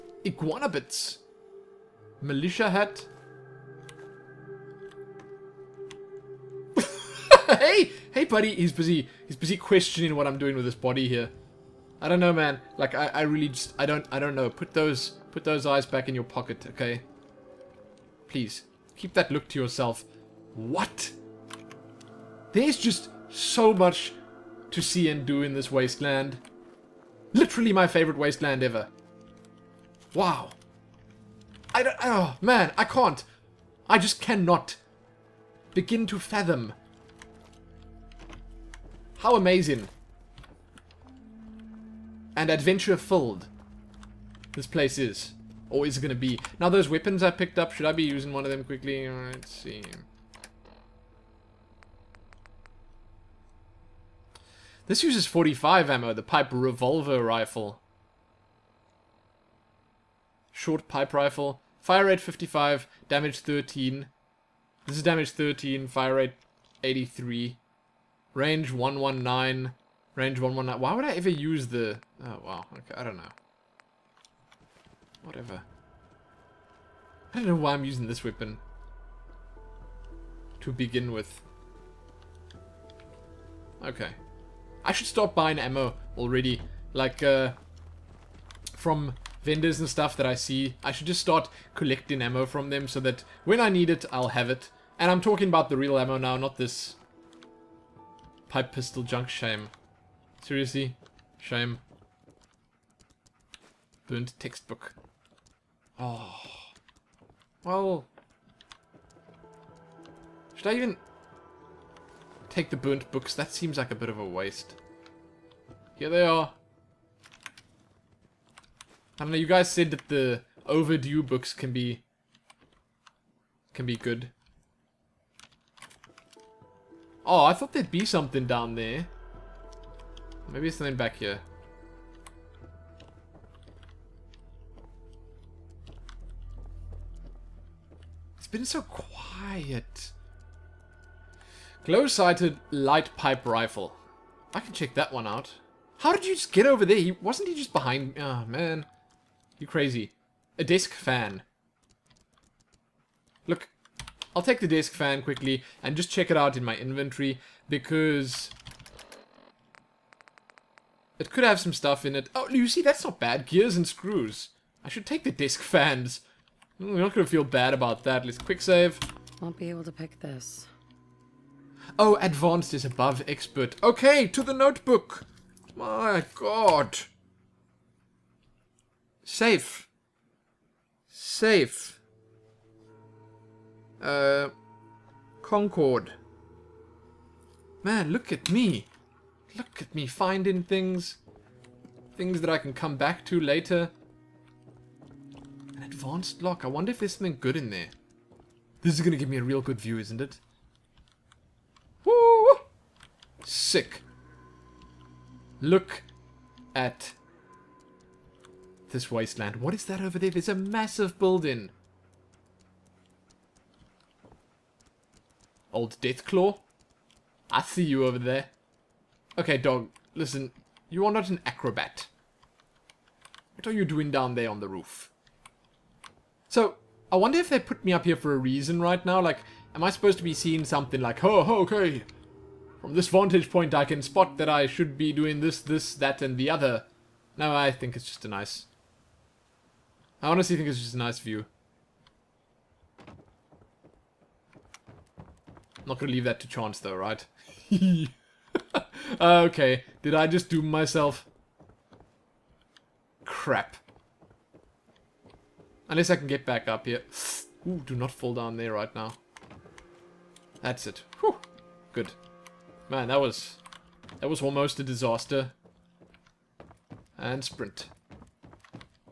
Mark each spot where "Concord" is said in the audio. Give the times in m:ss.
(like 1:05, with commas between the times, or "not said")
3:05.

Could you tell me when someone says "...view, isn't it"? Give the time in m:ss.
3:19.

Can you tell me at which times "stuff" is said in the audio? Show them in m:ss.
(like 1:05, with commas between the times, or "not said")
1:29, 2:41.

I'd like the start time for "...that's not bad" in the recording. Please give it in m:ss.
2:42.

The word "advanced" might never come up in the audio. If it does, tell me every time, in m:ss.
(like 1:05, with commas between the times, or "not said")
2:52, 3:16.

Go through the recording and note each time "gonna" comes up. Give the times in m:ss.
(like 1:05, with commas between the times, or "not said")
2:47, 4:05.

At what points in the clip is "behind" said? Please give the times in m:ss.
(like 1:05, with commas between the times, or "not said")
2:27.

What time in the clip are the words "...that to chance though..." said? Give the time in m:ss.
4:06.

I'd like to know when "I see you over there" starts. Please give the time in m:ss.
3:37.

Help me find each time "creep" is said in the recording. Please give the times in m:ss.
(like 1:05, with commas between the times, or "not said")
not said.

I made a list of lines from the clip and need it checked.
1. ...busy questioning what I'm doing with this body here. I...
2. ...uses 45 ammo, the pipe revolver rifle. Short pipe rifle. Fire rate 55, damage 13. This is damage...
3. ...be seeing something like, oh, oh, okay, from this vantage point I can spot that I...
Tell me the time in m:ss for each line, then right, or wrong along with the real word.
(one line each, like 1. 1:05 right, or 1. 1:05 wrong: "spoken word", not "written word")
1. 0:09 right
2. 0:55 right
3. 3:50 right.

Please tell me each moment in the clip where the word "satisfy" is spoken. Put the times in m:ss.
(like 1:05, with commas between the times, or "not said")
not said.